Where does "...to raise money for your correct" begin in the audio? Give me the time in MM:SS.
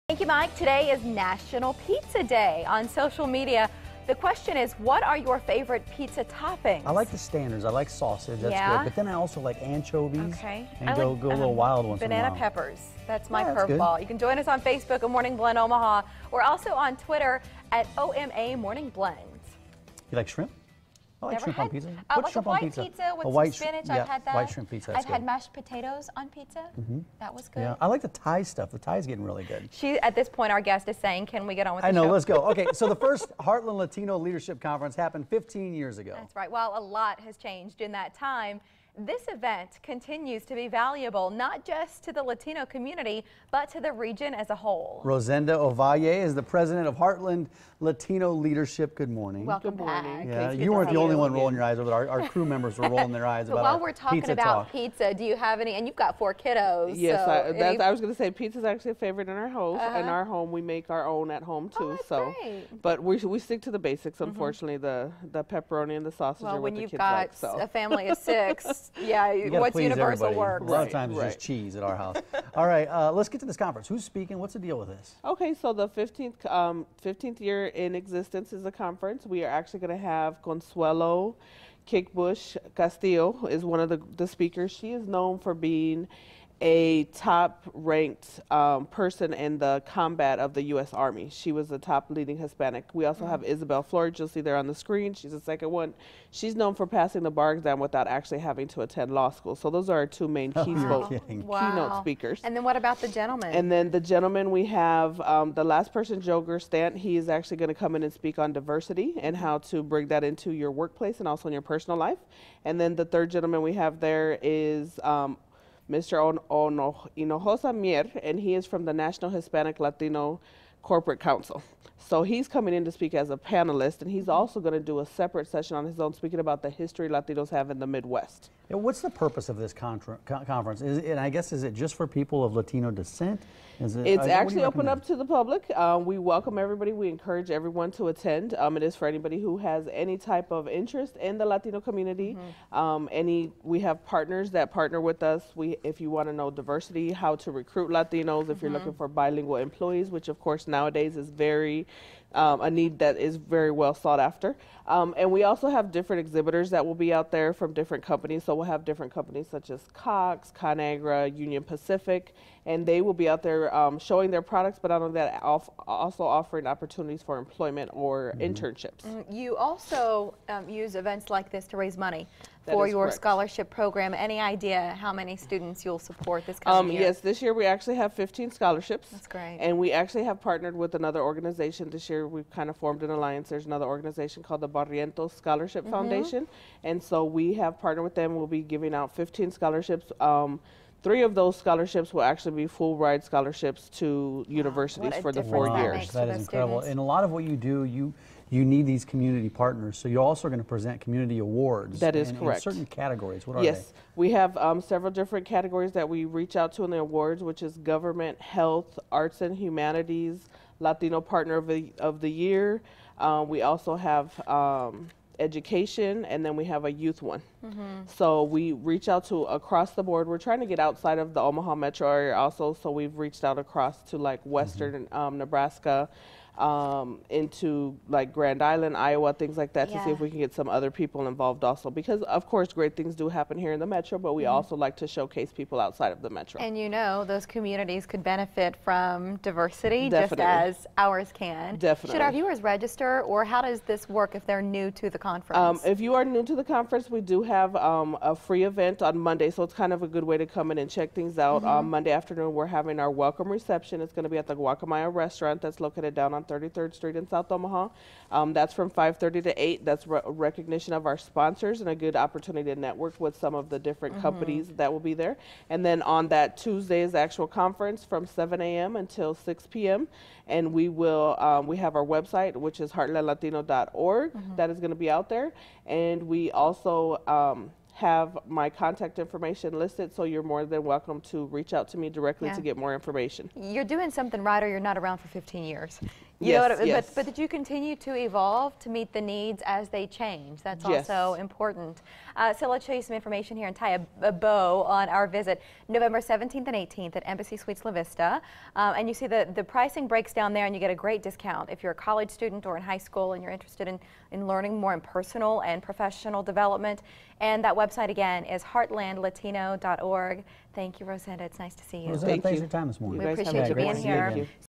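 02:51.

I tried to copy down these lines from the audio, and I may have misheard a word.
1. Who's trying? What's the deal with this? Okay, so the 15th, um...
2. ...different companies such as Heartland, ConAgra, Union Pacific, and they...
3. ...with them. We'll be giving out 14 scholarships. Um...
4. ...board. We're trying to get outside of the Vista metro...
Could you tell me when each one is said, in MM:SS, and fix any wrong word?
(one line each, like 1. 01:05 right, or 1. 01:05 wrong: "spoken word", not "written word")
1. 01:13 wrong: "speaking", not "trying"
2. 02:38 wrong: "Cox", not "Heartland"
3. 03:08 wrong: "15", not "14"
4. 03:40 wrong: "Omaha", not "Vista".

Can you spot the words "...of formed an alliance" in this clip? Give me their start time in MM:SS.
03:02.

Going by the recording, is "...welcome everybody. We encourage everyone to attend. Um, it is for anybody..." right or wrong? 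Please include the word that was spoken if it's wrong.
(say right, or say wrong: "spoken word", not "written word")
right.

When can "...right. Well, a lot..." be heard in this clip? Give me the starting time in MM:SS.
00:36.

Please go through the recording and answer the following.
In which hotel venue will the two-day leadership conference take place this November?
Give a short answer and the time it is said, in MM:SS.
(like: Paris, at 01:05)
Embassy Suites La Vista, at 04:57.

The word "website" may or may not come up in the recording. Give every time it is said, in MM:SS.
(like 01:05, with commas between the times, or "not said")
04:32, 05:07.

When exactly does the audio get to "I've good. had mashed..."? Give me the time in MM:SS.
00:24.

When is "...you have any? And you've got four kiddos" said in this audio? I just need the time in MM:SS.
00:55.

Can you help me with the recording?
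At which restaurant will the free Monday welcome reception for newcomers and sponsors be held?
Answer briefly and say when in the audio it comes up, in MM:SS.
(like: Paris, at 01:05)
Guacamaya, at 04:14.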